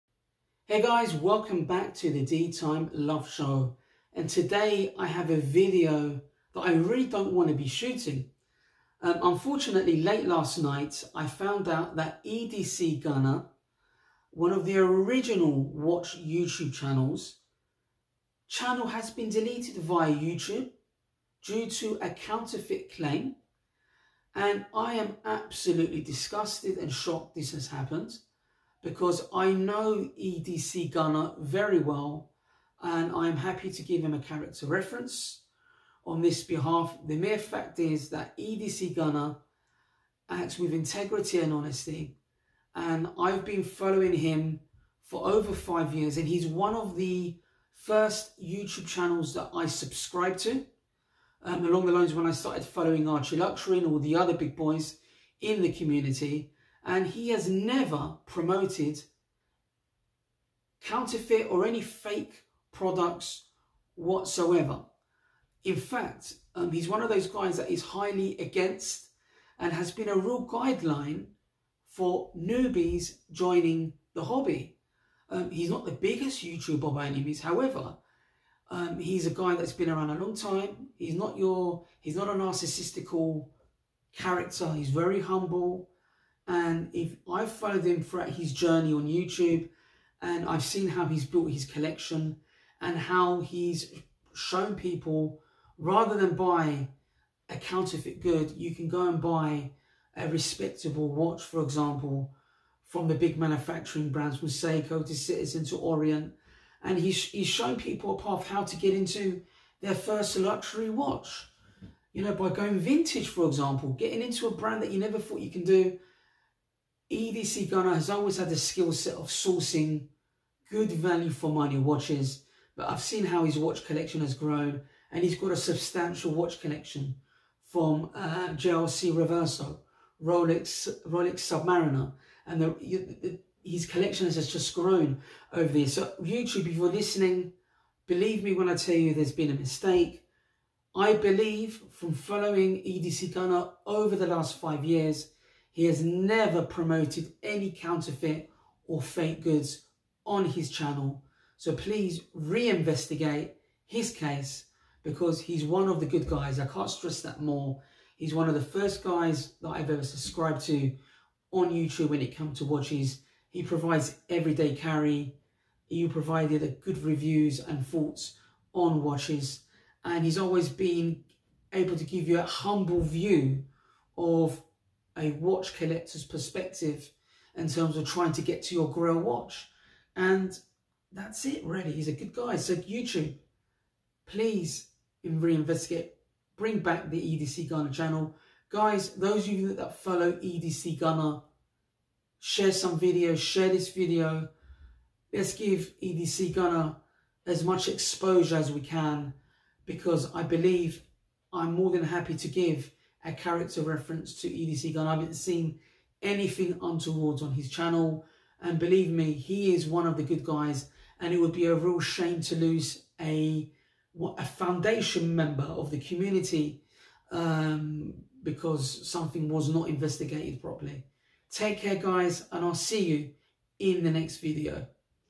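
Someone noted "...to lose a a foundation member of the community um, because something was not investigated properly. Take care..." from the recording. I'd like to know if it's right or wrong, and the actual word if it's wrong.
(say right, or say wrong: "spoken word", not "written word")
right.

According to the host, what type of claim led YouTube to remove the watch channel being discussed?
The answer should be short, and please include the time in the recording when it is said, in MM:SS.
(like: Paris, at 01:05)
Counterfeit claim, at 00:22.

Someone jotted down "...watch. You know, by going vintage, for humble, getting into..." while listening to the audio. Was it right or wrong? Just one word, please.
wrong.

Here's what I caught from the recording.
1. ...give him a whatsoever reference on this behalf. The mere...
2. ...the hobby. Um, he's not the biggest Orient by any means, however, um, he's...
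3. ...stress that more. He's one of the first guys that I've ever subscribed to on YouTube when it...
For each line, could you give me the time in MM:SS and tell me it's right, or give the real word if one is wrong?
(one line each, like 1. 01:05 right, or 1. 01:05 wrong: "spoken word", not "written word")
1. 00:33 wrong: "character", not "whatsoever"
2. 01:14 wrong: "YouTuber", not "Orient"
3. 02:36 right.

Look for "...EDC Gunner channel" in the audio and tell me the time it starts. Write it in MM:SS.
03:07.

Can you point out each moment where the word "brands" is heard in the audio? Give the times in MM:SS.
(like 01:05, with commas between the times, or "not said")
01:44, 01:54.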